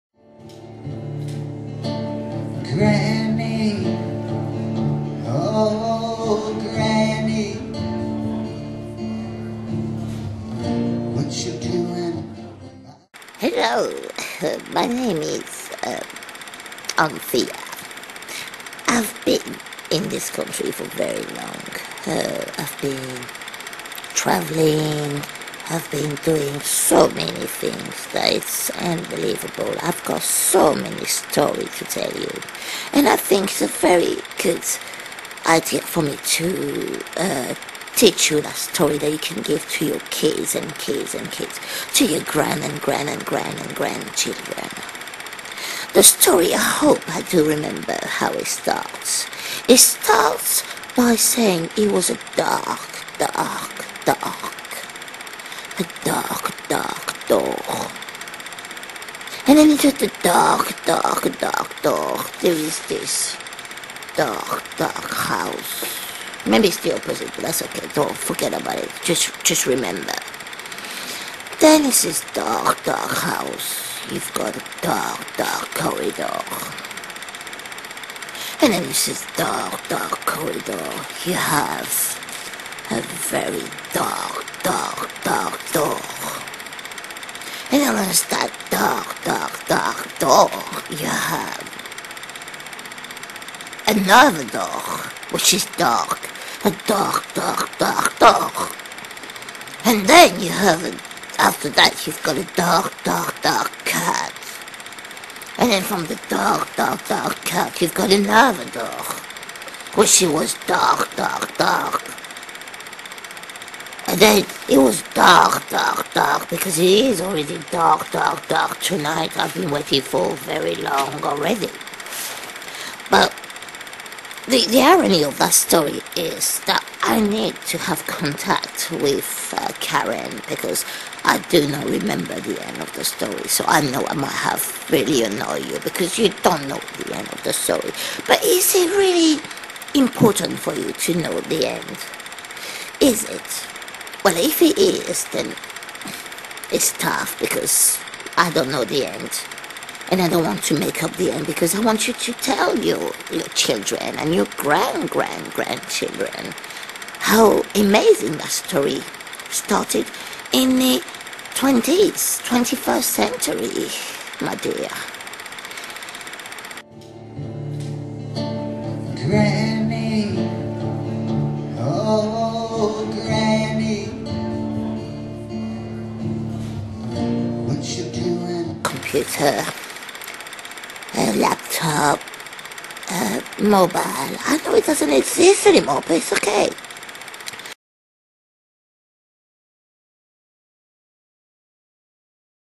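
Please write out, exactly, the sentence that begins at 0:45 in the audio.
The story, I hope I do remember how it starts.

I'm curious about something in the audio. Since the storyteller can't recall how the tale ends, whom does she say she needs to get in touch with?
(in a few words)
Karen.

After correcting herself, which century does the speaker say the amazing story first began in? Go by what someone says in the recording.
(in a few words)
21st century.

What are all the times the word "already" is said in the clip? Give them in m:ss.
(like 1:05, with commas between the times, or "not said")
1:57, 2:01.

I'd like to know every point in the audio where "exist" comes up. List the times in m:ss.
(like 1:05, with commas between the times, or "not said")
3:05.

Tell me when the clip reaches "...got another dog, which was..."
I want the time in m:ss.
1:47.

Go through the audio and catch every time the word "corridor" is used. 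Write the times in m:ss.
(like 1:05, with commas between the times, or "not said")
1:15, 1:20.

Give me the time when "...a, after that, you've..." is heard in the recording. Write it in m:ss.
1:40.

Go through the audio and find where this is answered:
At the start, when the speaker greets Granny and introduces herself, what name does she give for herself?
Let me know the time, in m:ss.
0:16.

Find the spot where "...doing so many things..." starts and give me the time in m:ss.
0:26.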